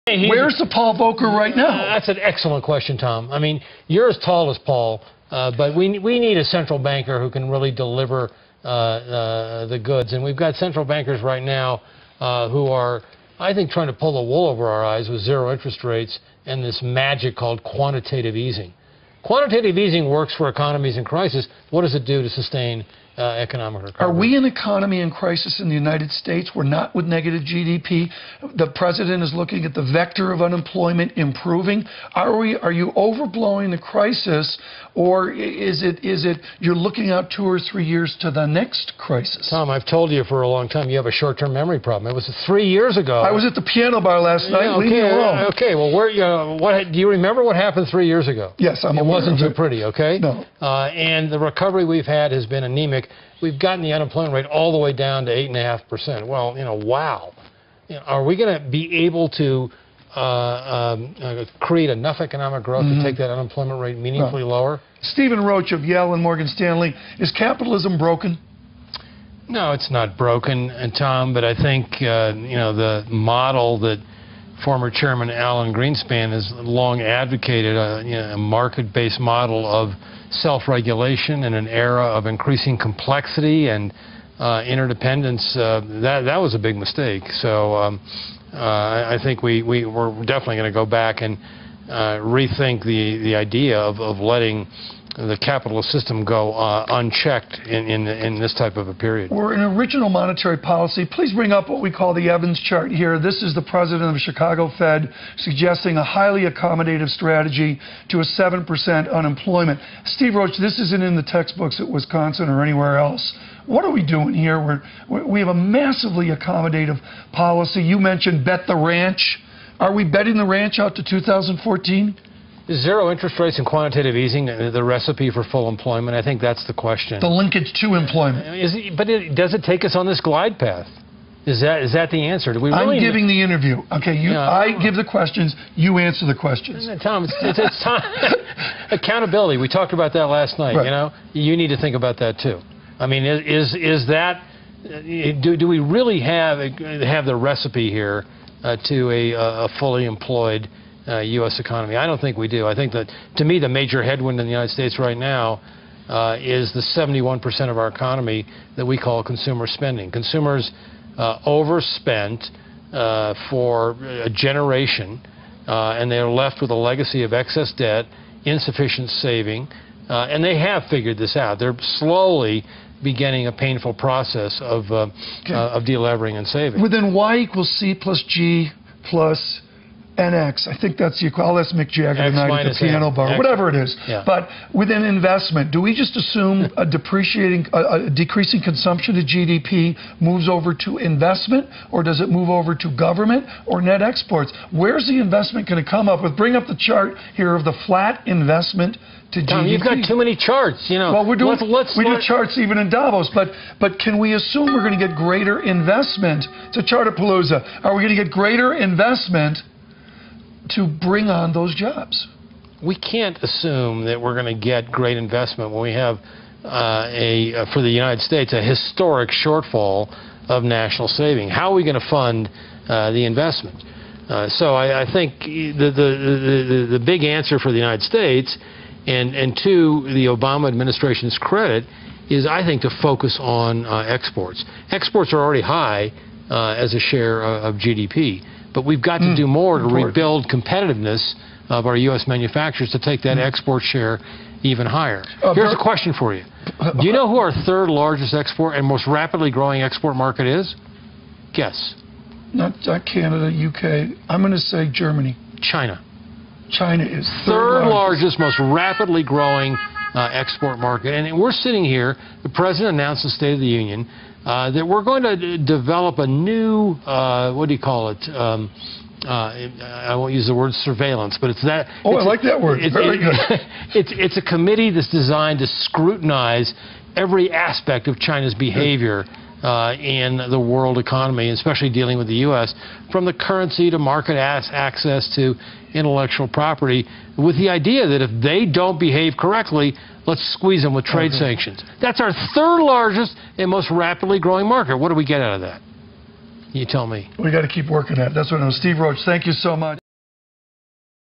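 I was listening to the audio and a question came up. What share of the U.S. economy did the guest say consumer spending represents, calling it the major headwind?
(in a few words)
71%.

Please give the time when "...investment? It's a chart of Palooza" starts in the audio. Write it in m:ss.
3:25.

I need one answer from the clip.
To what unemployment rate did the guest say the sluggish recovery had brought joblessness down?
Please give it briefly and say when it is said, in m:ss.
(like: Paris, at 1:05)
8.5%, at 0:55.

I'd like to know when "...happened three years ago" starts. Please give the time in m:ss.
0:47.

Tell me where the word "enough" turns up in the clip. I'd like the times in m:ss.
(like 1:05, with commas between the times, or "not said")
1:01.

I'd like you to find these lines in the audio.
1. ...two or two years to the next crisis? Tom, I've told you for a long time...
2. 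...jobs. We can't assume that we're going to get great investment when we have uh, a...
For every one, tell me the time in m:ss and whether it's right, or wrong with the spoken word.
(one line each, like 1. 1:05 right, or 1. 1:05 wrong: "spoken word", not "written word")
1. 0:37 wrong: "three", not "two"
2. 3:31 right.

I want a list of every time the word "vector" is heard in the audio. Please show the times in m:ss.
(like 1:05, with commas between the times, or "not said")
0:29.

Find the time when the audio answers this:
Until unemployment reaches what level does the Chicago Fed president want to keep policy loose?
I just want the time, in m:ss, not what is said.
1:48.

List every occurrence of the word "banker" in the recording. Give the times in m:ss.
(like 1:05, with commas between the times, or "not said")
0:06, 0:10.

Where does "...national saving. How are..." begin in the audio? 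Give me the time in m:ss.
3:40.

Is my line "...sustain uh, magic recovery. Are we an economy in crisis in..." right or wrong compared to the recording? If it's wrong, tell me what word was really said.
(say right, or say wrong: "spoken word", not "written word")
wrong: "economic", not "magic".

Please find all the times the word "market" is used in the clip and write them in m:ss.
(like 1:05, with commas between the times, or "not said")
1:18, 4:10, 4:20, 4:43, 4:54.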